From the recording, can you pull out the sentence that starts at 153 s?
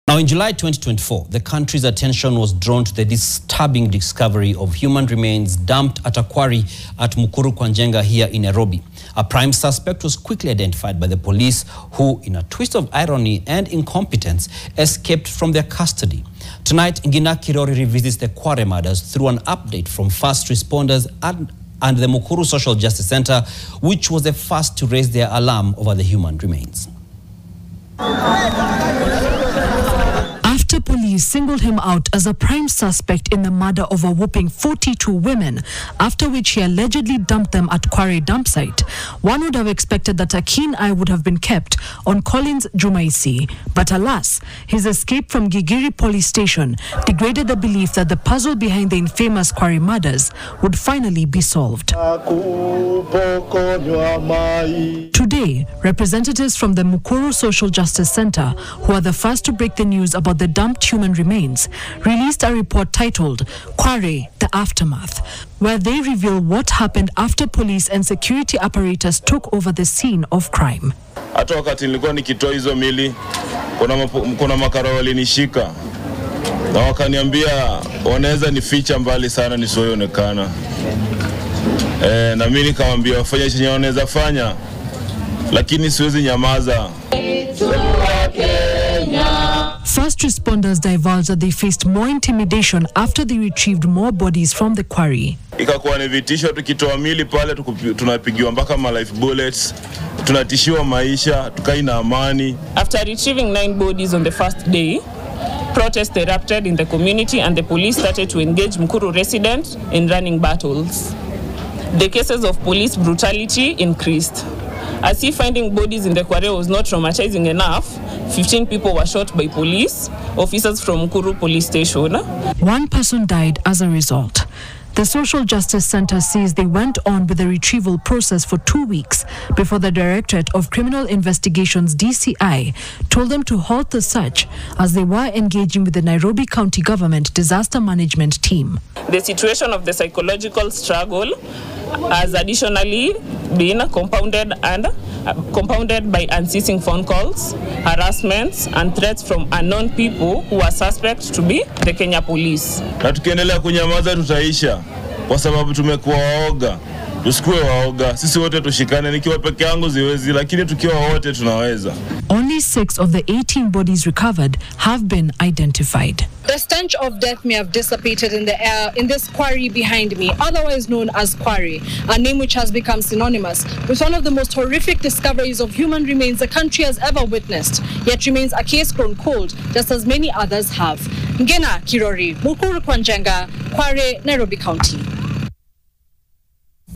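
Na tukiendelea kunyamaza tutaisha kwa sababu tumekuwa waoga.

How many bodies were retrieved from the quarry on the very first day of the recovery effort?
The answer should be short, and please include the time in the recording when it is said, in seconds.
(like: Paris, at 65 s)
9, at 103 s.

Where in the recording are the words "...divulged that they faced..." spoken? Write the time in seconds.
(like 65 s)
90 s.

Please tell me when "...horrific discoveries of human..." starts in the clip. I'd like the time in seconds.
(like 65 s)
174 s.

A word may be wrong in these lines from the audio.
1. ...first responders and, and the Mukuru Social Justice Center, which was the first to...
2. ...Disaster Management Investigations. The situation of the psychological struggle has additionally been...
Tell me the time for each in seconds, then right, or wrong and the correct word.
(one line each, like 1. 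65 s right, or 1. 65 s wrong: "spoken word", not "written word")
1. 20 s right
2. 137 s wrong: "Team", not "Investigations".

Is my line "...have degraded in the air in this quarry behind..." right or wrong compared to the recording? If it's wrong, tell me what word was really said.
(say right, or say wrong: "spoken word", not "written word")
wrong: "dissipated", not "degraded".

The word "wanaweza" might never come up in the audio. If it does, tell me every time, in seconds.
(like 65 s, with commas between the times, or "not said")
78 s, 83 s.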